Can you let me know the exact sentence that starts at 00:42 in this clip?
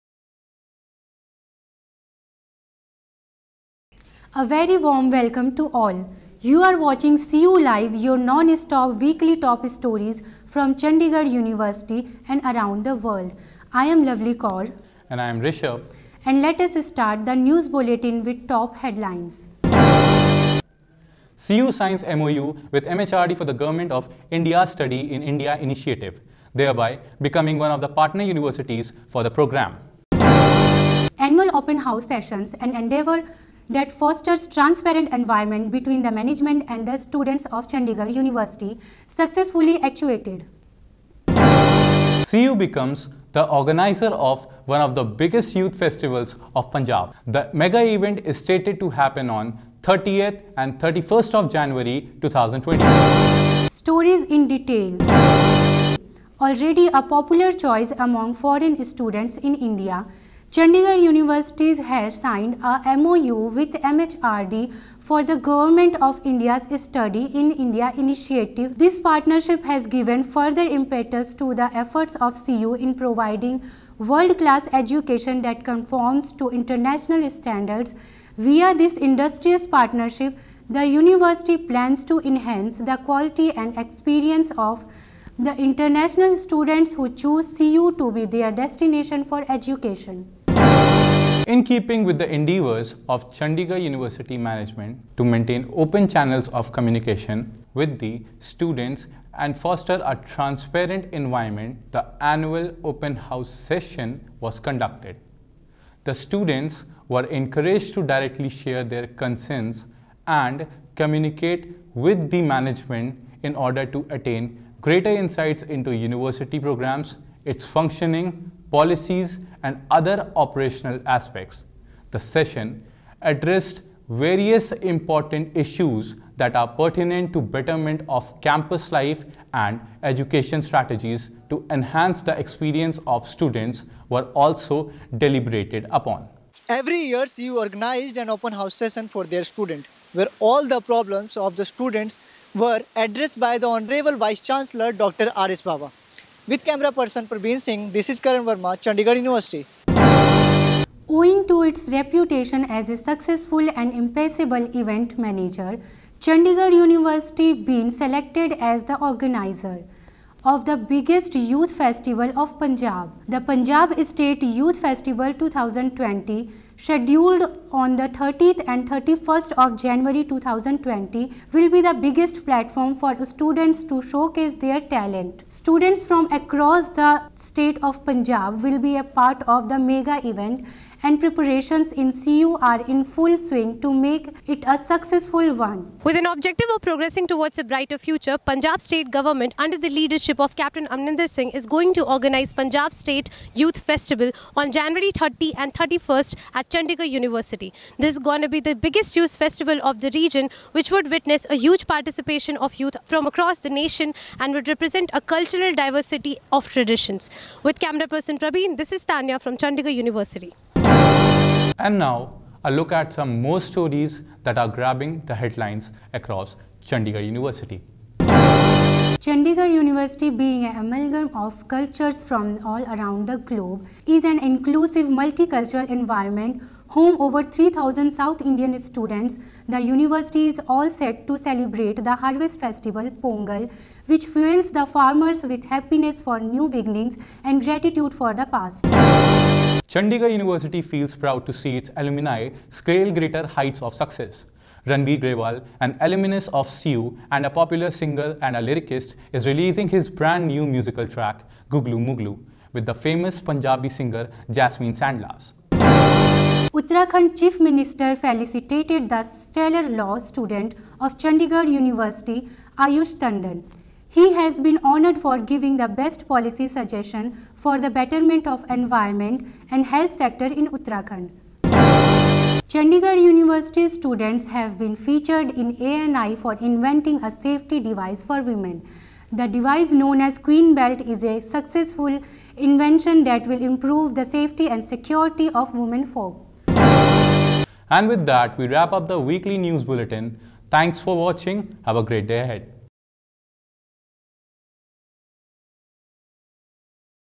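CU becomes the organizer of one of the biggest youth festivals of Punjab.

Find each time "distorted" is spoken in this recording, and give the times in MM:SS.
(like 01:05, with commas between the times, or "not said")
not said.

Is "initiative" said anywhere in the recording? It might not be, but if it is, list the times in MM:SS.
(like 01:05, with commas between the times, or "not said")
00:25, 01:07.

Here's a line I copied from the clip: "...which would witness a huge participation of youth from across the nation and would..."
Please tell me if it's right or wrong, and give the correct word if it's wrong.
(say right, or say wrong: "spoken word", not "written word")
right.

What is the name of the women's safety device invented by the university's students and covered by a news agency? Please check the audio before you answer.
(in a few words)
Queen Belt.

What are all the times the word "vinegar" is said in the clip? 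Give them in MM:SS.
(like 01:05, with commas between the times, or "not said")
not said.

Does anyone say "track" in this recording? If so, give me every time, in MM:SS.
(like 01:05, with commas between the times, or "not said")
04:11.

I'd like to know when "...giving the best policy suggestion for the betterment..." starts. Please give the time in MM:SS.
04:25.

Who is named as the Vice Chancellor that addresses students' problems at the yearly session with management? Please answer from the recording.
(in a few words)
Dr. R.S. Bawa.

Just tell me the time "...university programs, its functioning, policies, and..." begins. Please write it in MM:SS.
01:55.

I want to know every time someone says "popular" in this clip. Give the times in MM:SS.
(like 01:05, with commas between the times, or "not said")
00:57, 04:07.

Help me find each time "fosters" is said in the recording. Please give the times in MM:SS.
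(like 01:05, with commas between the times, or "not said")
00:33, 01:39.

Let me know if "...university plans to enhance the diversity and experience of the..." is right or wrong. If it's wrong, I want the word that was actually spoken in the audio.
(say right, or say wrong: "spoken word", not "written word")
wrong: "quality", not "diversity".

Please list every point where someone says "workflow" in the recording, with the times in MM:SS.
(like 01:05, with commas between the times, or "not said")
not said.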